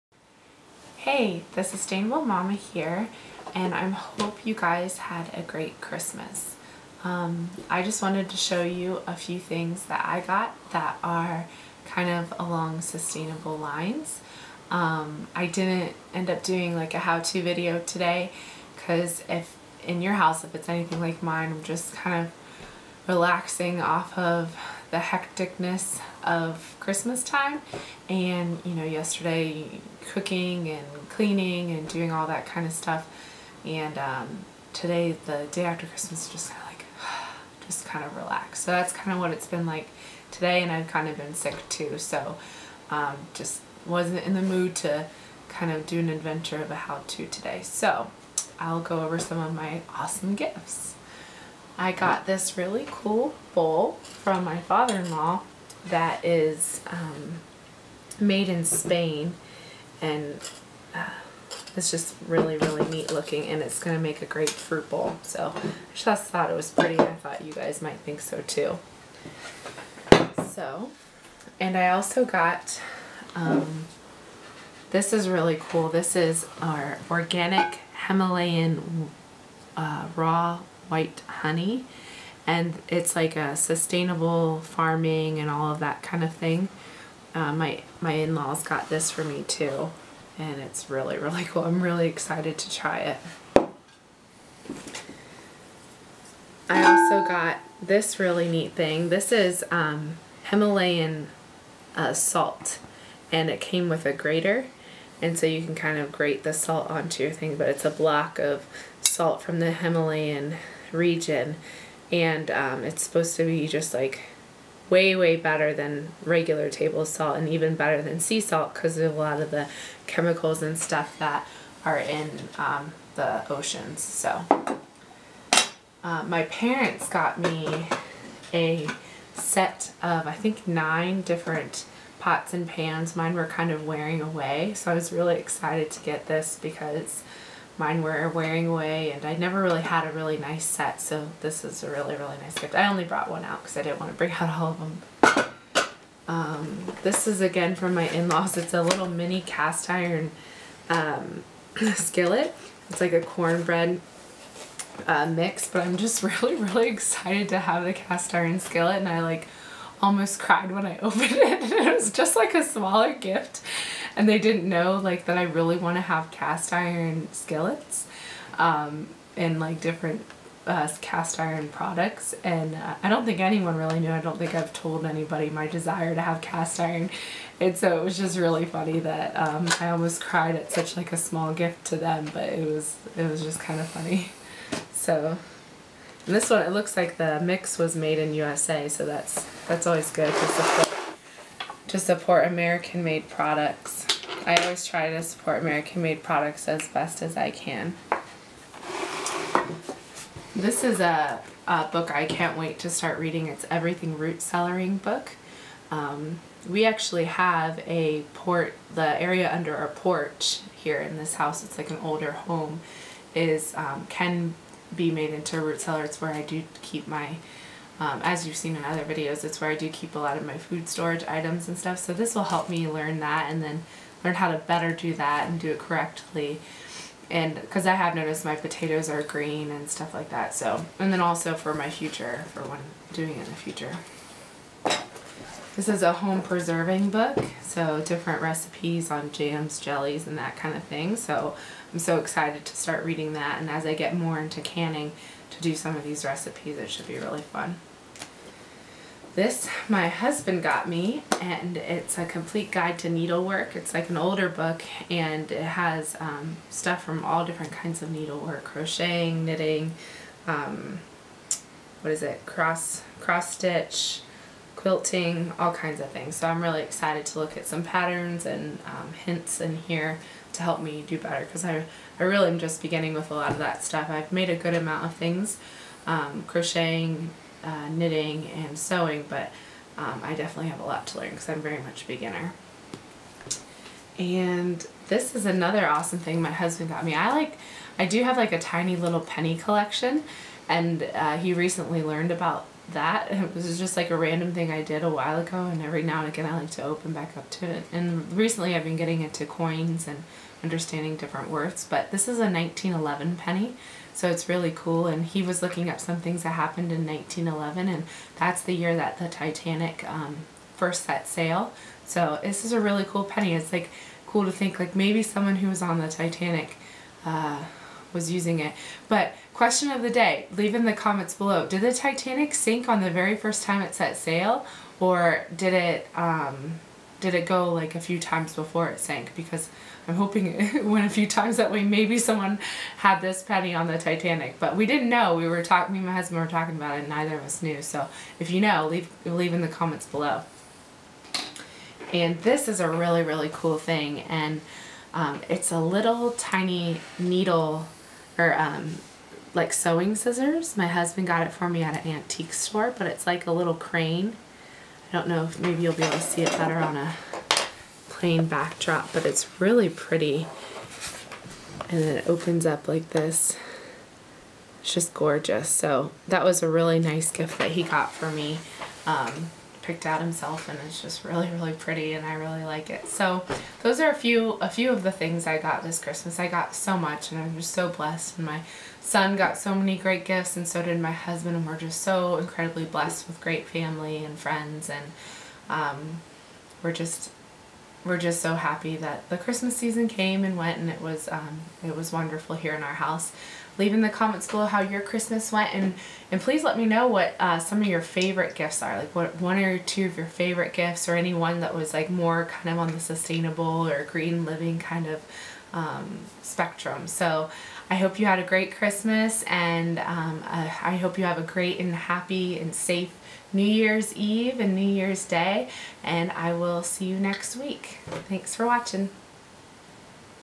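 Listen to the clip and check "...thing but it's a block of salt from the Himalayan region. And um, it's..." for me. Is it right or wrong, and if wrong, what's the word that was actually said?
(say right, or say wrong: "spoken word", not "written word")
right.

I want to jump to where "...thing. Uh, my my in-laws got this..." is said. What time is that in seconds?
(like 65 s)
86 s.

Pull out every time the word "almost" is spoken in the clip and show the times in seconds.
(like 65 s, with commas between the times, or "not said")
160 s, 179 s.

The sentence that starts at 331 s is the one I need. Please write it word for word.
Maybe someone had this penny on the Titanic, but we didn't know.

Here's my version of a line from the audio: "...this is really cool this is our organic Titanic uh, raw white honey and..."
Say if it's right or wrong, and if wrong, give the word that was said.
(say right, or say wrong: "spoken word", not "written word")
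wrong: "Himalayan", not "Titanic".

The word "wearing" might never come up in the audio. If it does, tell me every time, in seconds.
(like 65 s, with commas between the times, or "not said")
133 s, 138 s.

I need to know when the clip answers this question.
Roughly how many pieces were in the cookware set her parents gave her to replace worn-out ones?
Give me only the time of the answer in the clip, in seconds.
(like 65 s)
130 s.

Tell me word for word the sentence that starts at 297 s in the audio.
And recently I've been getting into coins and understanding different words, but this is a 1911 penny.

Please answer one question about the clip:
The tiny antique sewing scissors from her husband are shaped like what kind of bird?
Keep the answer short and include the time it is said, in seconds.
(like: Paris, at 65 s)
Crane, at 353 s.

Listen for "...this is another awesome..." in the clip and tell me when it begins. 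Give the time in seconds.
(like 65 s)
285 s.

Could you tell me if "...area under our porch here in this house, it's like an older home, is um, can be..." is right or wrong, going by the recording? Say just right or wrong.
right.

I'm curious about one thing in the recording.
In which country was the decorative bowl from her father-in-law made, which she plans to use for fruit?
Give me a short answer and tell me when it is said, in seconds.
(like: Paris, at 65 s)
Spain, at 58 s.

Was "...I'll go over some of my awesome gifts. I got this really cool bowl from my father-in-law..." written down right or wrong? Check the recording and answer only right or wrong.
right.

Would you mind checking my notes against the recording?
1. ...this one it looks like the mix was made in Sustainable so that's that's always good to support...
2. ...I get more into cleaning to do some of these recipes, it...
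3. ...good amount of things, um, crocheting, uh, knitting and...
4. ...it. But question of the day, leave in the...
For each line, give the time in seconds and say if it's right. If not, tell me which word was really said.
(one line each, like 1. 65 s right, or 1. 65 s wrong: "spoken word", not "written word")
1. 186 s wrong: "USA", not "Sustainable"
2. 243 s wrong: "canning", not "cleaning"
3. 274 s right
4. 318 s right.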